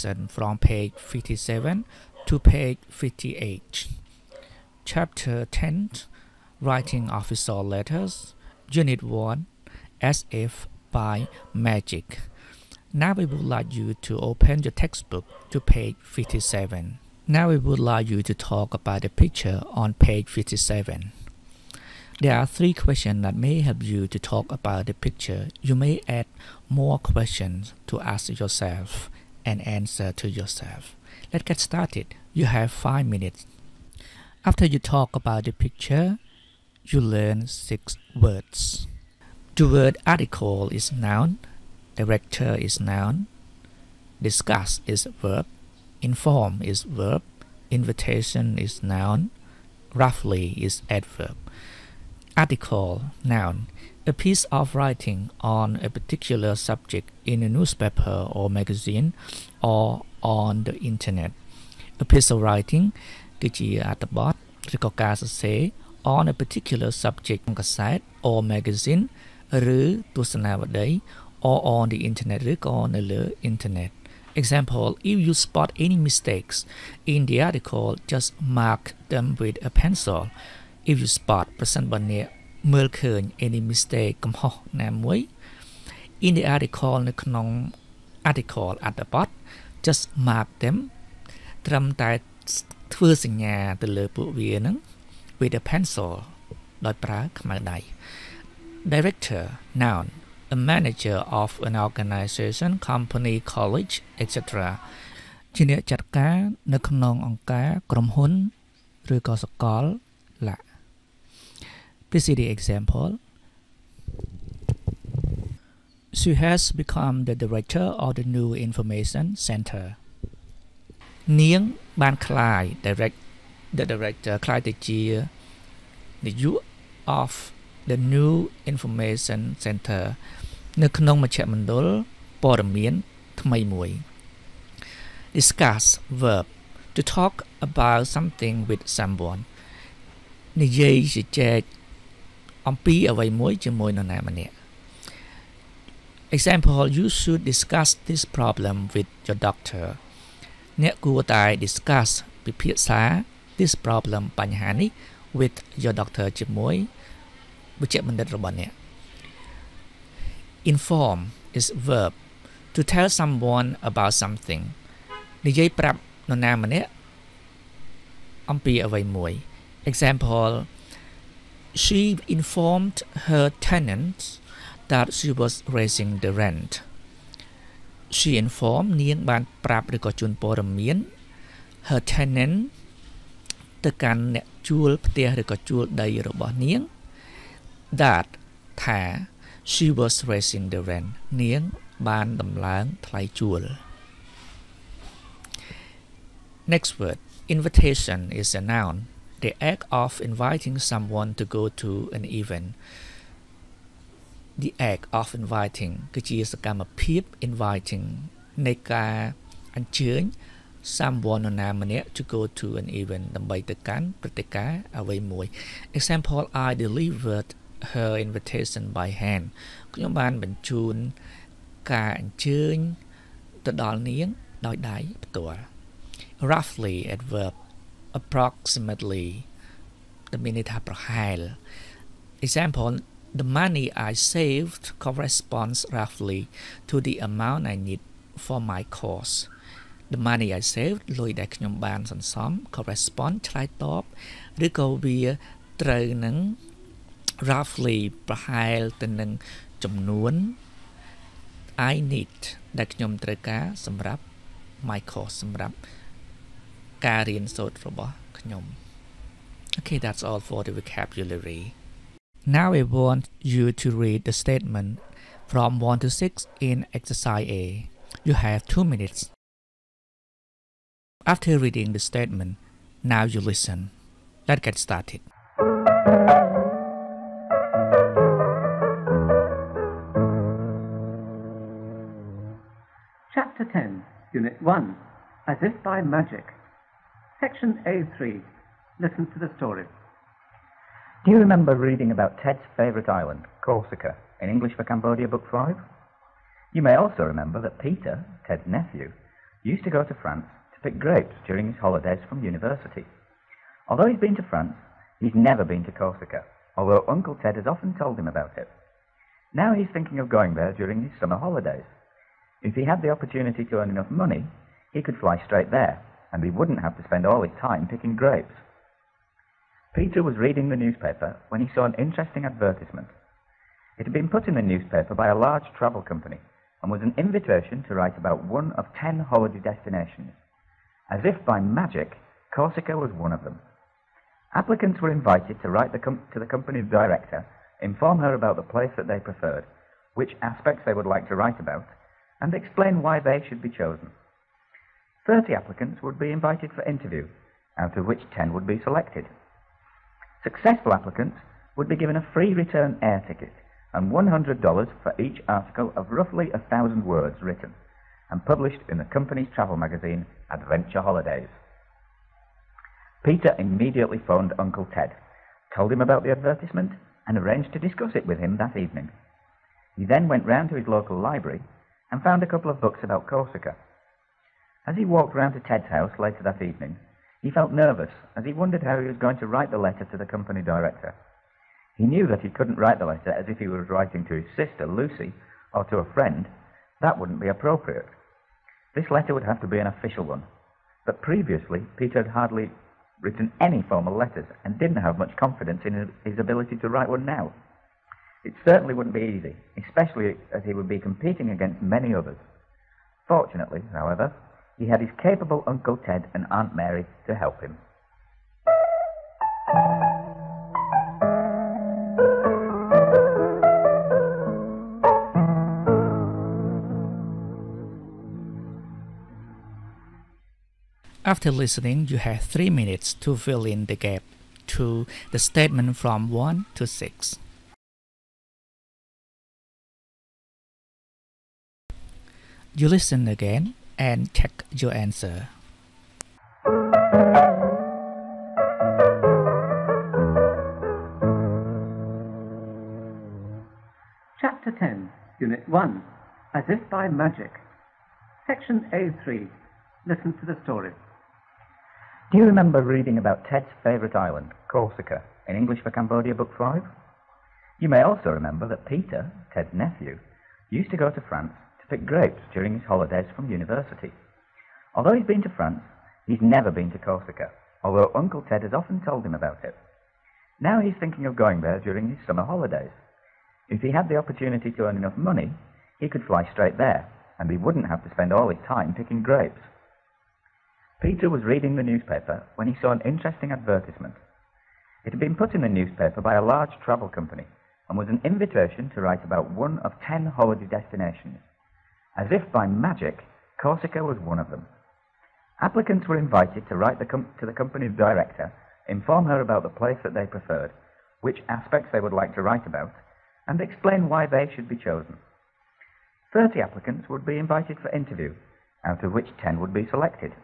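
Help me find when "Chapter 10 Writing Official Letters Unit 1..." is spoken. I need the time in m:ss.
0:04.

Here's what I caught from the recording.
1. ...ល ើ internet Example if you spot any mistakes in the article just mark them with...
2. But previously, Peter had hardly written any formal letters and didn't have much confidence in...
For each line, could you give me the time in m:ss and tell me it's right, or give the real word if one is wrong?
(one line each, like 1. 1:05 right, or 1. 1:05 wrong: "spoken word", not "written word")
1. 1:13 right
2. 6:31 right.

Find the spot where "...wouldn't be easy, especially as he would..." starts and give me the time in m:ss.
6:38.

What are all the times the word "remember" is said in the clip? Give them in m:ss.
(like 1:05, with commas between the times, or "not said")
4:51, 4:57, 7:32, 7:38.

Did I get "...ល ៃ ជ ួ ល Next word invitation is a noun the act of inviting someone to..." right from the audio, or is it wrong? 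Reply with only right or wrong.
right.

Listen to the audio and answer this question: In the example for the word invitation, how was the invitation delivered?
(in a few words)
by hand.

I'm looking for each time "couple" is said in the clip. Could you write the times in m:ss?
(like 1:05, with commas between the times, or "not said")
6:12.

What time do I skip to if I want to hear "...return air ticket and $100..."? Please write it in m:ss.
5:52.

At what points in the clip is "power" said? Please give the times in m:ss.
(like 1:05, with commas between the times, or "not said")
not said.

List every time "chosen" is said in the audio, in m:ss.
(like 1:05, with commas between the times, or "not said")
5:43, 8:24.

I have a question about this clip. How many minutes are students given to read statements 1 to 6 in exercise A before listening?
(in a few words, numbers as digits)
2 minutes.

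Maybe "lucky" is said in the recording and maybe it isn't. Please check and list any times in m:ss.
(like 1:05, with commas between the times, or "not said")
not said.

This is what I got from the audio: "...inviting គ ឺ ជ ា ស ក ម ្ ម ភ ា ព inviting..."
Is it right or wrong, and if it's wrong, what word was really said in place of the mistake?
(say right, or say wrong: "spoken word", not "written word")
right.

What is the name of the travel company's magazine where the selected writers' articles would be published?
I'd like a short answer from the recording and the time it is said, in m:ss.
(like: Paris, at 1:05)
Adventure Holidays, at 6:00.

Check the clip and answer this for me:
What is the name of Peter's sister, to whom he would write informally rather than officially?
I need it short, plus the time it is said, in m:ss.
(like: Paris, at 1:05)
Lucy, at 6:24.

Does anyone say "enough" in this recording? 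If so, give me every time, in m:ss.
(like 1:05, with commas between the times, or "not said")
5:13, 7:54.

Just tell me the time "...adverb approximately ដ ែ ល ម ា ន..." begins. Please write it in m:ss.
3:47.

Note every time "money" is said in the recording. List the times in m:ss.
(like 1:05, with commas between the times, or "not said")
3:53, 4:00, 5:14, 7:55.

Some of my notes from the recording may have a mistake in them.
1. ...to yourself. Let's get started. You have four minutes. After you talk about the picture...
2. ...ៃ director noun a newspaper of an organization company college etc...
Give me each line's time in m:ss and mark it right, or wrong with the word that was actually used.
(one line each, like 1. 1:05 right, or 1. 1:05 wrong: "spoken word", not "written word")
1. 0:30 wrong: "five", not "four"
2. 1:37 wrong: "manager", not "newspaper".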